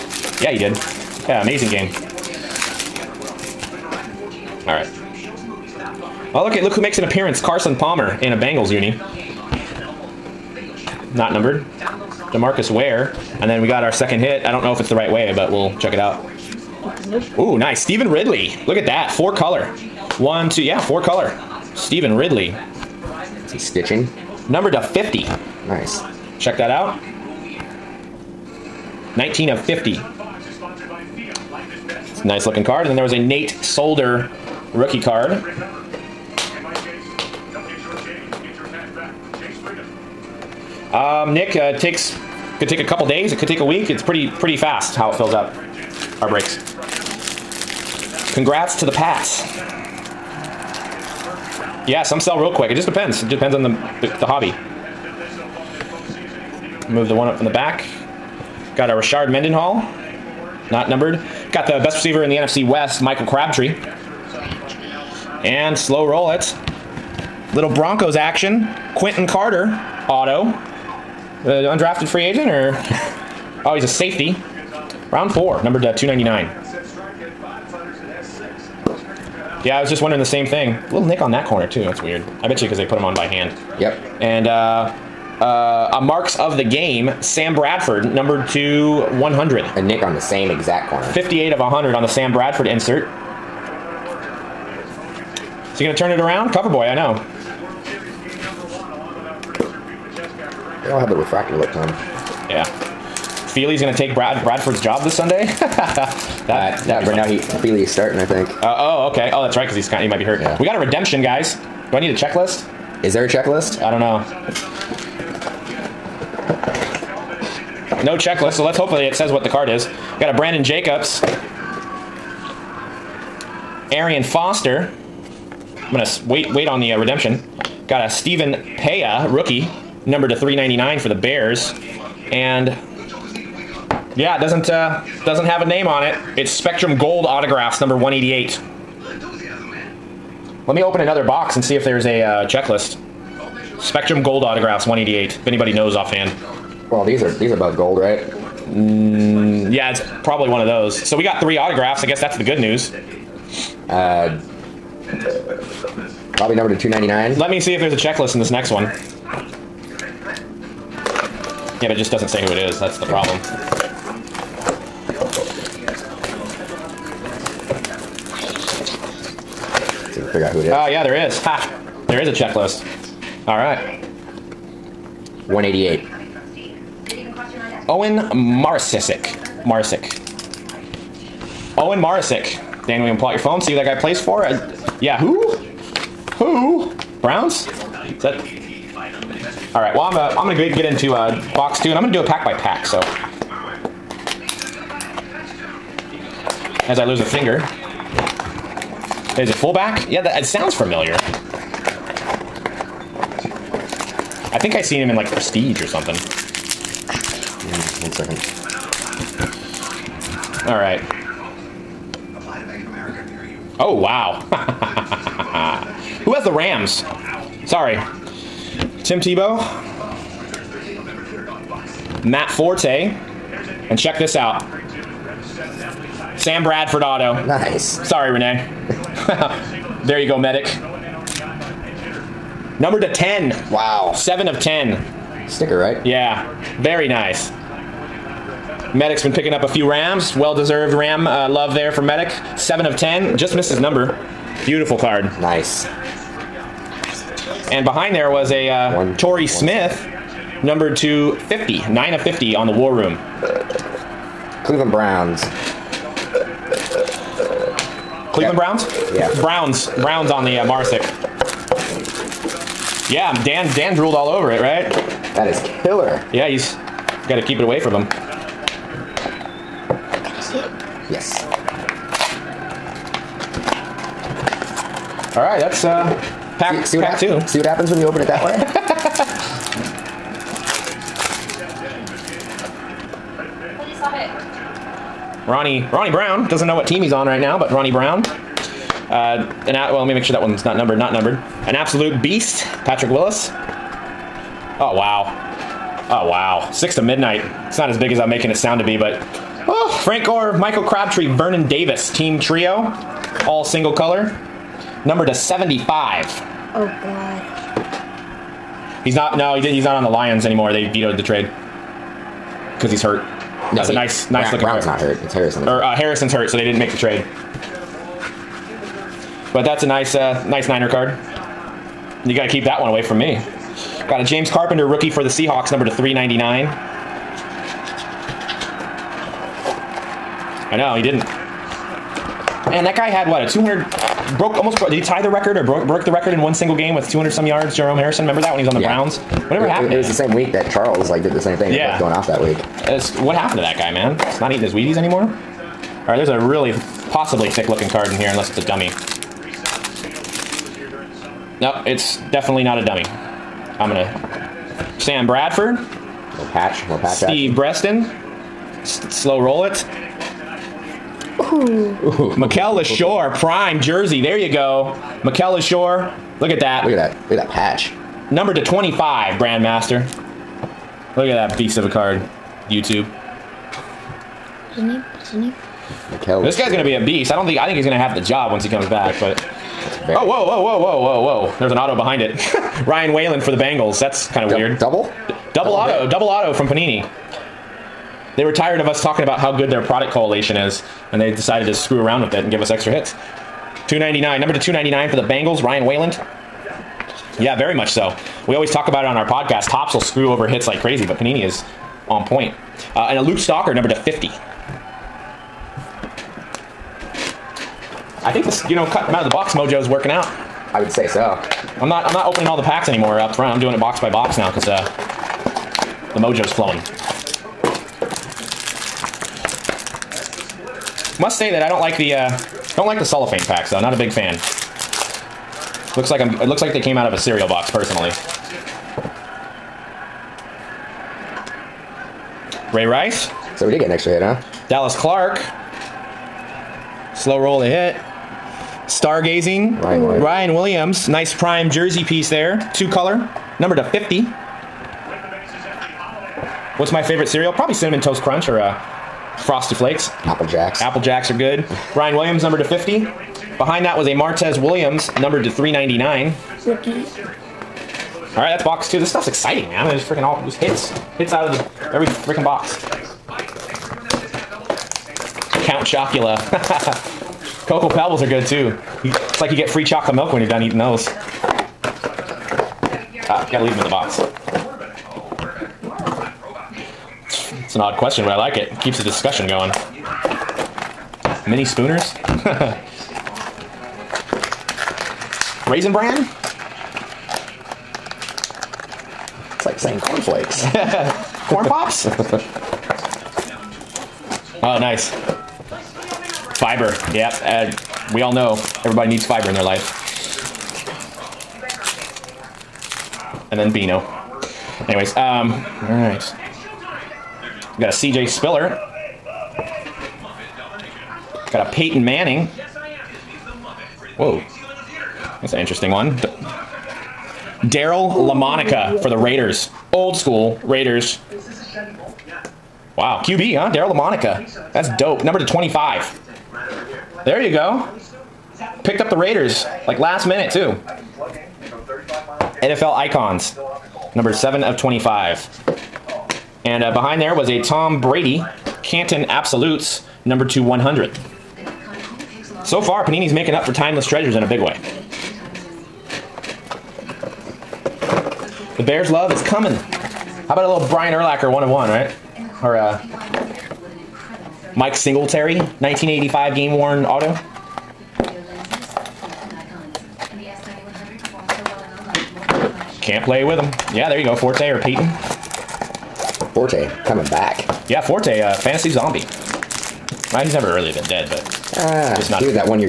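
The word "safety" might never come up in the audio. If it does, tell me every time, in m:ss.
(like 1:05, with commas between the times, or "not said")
1:13.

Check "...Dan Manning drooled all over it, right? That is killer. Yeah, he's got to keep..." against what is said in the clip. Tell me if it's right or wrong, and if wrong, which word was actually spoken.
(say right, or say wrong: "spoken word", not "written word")
wrong: "Dan", not "Manning".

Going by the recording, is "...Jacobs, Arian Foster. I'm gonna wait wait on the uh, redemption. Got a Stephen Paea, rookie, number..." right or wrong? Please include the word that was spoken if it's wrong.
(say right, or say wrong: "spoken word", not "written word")
right.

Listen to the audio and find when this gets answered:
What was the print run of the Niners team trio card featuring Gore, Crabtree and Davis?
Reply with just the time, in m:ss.
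5:05.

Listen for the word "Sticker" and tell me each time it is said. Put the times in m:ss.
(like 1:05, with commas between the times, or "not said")
3:55.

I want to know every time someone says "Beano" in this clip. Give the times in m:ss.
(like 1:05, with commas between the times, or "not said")
8:23.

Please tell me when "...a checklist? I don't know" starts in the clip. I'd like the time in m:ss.
1:53.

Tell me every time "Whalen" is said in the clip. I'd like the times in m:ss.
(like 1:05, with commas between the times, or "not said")
6:23, 6:35.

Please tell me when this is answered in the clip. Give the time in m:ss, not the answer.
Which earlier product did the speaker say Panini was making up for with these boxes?
9:03.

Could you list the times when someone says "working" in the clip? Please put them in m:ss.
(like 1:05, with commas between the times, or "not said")
6:49.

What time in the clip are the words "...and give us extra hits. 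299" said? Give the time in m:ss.
6:32.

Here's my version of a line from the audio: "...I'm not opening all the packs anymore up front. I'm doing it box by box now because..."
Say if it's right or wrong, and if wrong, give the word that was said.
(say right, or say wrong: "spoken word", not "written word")
right.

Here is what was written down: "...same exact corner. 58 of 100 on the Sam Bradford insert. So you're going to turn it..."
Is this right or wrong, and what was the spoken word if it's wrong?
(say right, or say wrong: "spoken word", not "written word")
right.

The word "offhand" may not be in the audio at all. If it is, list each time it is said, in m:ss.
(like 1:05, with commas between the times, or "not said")
2:25.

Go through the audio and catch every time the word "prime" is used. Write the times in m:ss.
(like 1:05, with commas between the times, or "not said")
6:03, 7:21.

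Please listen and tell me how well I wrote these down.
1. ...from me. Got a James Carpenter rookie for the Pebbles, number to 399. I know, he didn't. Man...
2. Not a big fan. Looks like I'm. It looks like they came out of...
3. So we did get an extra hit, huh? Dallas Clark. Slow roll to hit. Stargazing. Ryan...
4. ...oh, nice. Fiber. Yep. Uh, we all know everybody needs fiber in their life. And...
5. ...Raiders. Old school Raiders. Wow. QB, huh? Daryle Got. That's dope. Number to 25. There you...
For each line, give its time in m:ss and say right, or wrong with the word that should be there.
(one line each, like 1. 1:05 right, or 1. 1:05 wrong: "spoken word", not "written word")
1. 5:23 wrong: "Seahawks", not "Pebbles"
2. 7:03 right
3. 7:13 right
4. 8:14 right
5. 8:39 wrong: "Lamonica", not "Got".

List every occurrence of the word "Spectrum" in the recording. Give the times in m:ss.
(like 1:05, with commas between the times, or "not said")
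2:16, 2:23.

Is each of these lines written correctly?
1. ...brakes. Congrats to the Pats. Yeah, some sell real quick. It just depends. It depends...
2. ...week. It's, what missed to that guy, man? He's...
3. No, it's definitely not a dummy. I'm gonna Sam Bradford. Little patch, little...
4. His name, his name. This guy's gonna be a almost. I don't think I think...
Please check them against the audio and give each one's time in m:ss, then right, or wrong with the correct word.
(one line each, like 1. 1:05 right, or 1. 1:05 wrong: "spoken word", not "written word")
1. 0:46 right
2. 5:42 wrong: "happened", not "missed"
3. 5:51 right
4. 6:14 wrong: "beast", not "almost".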